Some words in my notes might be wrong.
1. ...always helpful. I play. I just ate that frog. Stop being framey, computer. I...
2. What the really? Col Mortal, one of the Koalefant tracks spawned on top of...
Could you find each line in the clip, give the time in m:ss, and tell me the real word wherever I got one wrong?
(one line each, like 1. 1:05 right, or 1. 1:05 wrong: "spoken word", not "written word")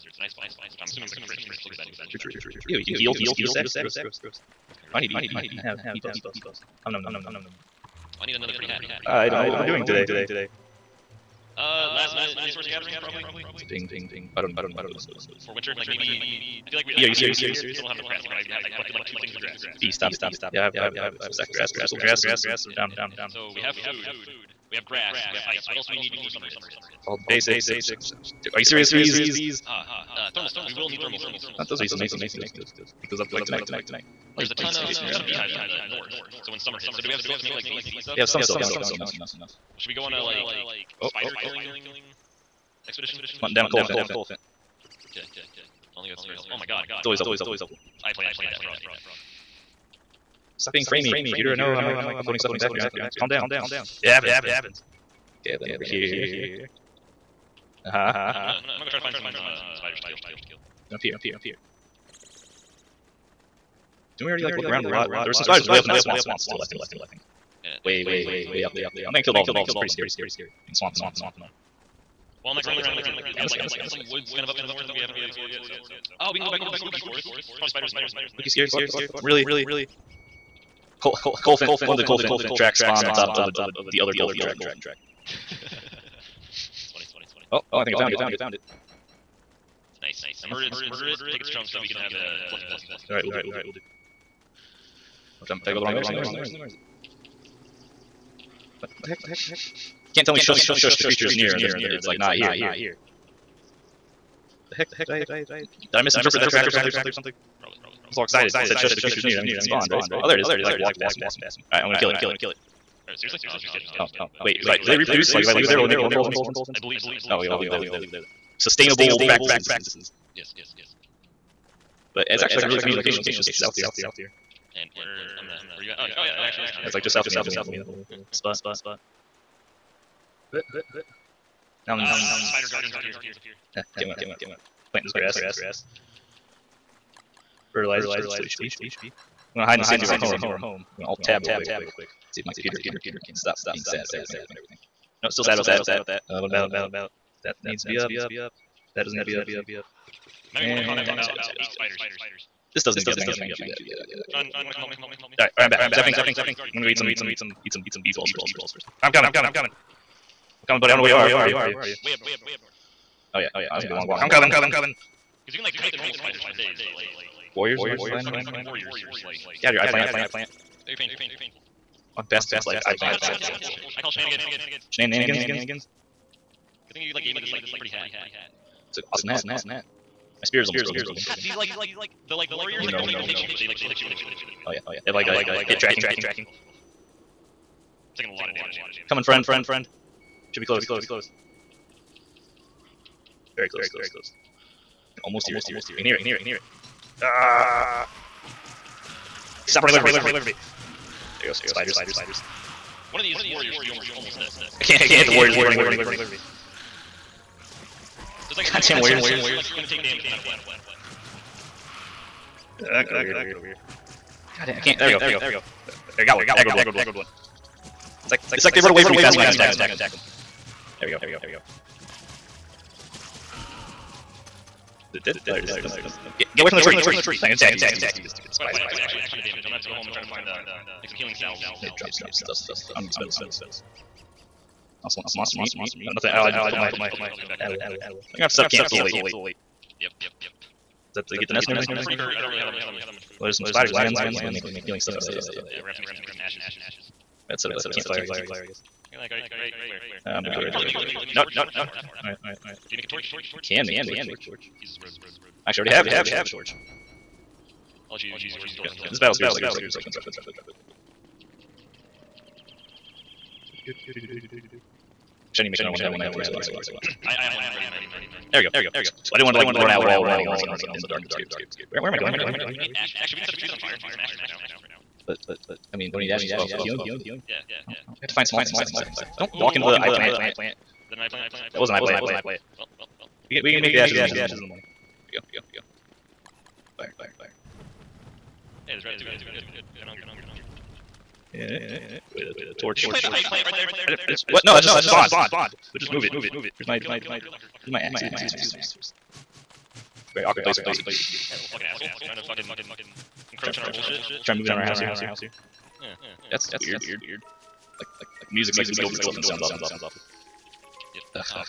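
1. 0:47 right
2. 1:18 wrong: "Koalefant", not "Mortal".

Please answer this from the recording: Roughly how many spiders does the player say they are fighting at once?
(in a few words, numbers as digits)
8.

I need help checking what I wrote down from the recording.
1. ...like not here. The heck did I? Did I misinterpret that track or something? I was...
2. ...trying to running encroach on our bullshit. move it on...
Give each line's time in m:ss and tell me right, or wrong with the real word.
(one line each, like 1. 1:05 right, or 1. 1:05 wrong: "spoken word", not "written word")
1. 1:42 right
2. 5:02 wrong: "fucking", not "running".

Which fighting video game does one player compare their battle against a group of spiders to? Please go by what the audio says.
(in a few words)
Mortal Kombat.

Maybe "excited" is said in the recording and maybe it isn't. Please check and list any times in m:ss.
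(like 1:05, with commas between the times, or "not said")
1:48.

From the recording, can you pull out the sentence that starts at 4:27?
I, I have one ready in my inventory.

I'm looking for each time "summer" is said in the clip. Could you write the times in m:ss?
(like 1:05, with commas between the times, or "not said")
0:26, 0:36.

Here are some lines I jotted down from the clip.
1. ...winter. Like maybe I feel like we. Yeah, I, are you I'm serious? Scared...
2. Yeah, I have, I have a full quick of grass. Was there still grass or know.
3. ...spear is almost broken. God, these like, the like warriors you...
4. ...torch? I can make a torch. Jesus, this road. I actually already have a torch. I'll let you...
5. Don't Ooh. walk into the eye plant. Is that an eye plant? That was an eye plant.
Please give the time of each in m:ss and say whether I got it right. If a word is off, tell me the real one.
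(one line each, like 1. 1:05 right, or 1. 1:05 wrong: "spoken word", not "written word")
1. 0:15 right
2. 0:20 wrong: "stack", not "quick"
3. 3:00 right
4. 4:13 right
5. 4:39 right.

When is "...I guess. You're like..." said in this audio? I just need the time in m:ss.
4:08.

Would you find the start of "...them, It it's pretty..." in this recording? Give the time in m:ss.
1:09.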